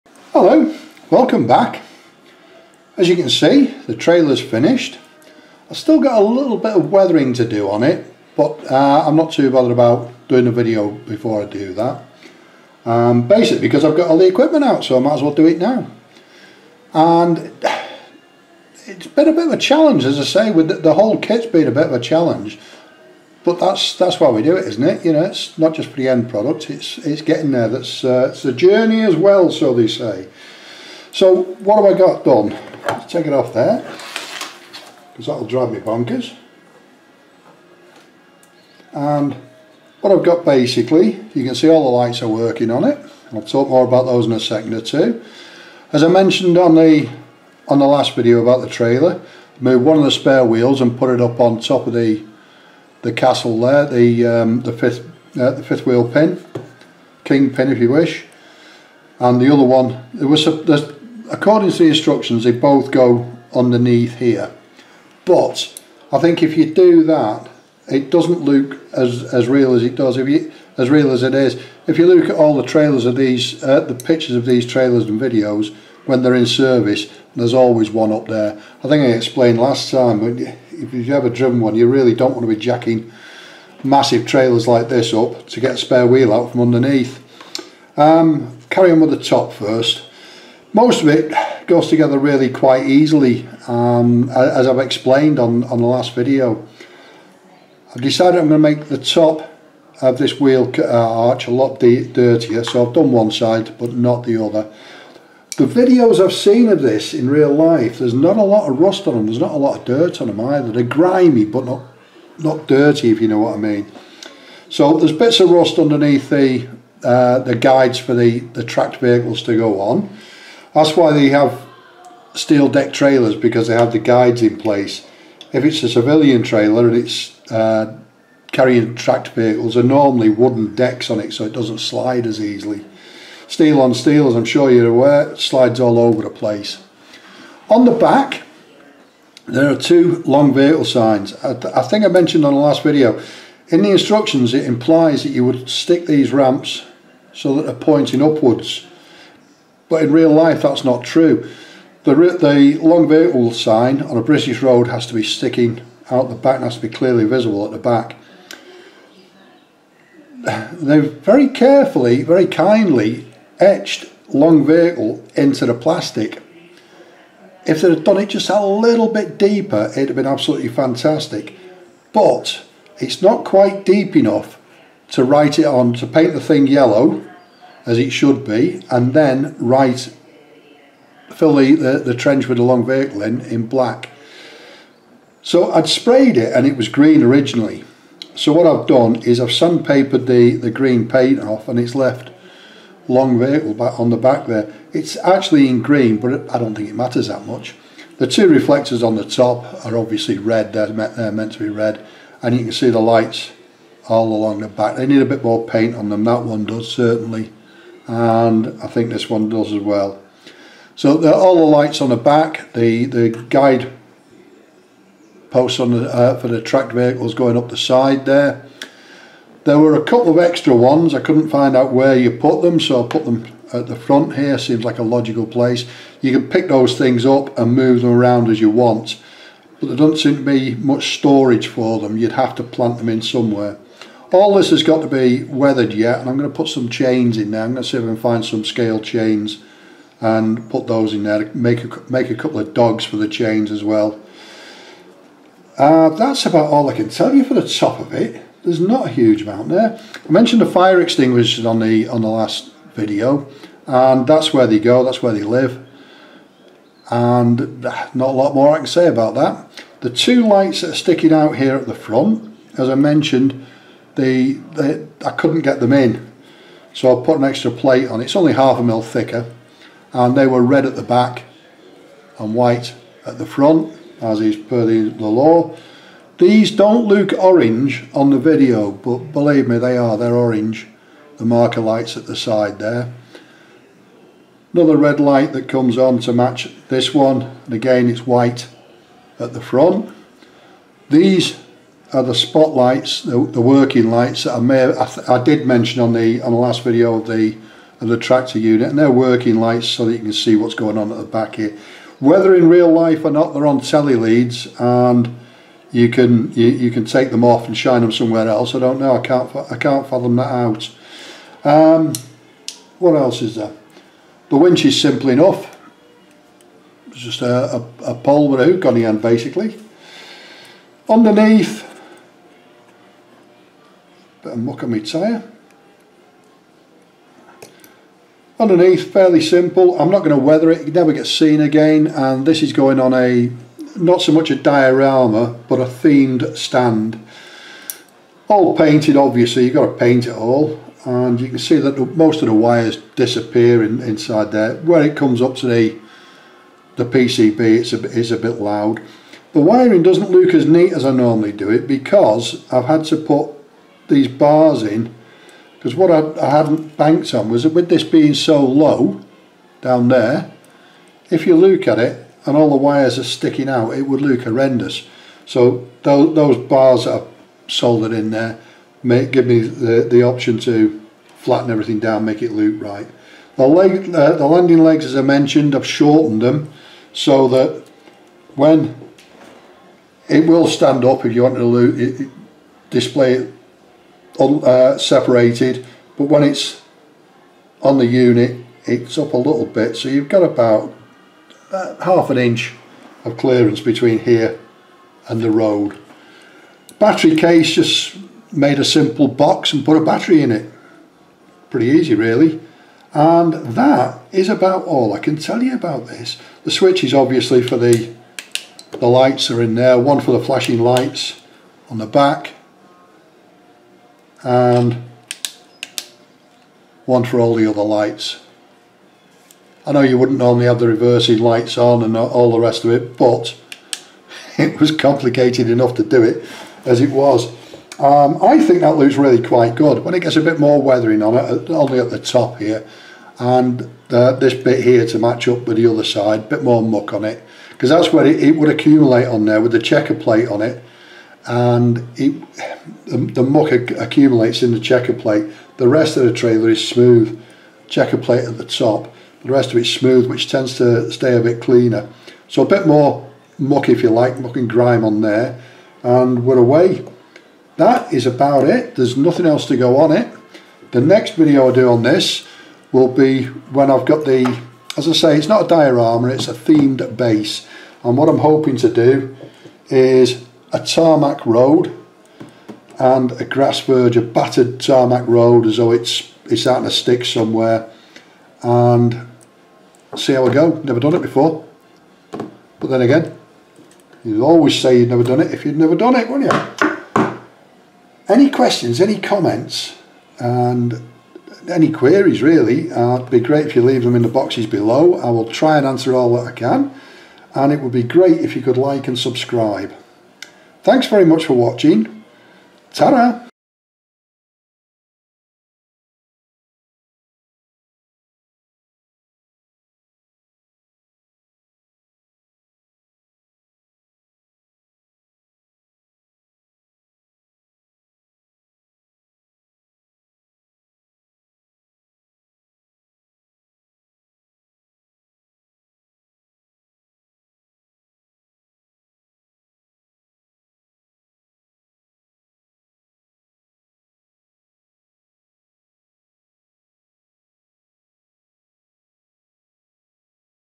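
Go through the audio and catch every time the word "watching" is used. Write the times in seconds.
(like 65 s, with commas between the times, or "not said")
501 s.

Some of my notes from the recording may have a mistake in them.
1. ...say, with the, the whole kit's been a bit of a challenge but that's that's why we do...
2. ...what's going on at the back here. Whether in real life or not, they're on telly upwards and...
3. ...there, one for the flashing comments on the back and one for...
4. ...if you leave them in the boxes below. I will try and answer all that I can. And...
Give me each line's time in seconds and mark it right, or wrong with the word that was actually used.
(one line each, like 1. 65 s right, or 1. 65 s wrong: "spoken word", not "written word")
1. 20 s right
2. 300 s wrong: "leads", not "upwards"
3. 409 s wrong: "lights", not "comments"
4. 493 s right.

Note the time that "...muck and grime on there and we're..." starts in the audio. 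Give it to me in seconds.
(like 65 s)
454 s.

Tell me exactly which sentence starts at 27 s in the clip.
That's uh, it's the journey as well, so they say.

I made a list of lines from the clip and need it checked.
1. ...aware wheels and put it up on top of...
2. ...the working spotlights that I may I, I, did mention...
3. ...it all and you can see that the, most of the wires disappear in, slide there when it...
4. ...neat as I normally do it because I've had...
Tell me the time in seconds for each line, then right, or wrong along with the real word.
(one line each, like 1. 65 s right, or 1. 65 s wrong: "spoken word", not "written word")
1. 50 s wrong: "spare", not "aware"
2. 293 s wrong: "lights", not "spotlights"
3. 340 s wrong: "inside", not "slide"
4. 350 s right.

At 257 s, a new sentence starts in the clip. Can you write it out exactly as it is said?
And ah, not a lot more I can say about that.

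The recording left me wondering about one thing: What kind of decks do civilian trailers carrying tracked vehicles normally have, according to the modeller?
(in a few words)
Wooden decks.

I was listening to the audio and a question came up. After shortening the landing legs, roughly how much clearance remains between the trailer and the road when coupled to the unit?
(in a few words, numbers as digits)
Half an inch.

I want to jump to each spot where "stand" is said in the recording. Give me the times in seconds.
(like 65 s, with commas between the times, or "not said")
336 s, 380 s.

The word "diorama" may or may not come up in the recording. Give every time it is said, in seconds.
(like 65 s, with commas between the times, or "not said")
334 s, 465 s.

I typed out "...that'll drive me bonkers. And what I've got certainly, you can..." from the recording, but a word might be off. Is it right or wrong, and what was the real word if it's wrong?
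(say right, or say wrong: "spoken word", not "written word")
wrong: "basically", not "certainly".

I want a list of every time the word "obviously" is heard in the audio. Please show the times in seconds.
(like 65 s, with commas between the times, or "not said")
199 s, 339 s, 407 s.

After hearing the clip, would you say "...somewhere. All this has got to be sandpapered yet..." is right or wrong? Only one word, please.
wrong.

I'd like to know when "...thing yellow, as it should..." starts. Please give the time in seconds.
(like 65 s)
176 s.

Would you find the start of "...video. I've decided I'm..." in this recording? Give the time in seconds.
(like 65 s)
96 s.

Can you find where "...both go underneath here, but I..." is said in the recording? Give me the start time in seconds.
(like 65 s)
62 s.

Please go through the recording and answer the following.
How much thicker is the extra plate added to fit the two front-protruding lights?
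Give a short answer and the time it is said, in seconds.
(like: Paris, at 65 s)
Half a mil, at 268 s.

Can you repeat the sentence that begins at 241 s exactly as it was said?
Make a, make a couple of dogs for the chains as well.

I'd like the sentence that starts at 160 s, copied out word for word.
They very carefully, very kindly etched long vehicle into the plastic.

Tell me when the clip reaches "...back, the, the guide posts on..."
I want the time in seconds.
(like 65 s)
212 s.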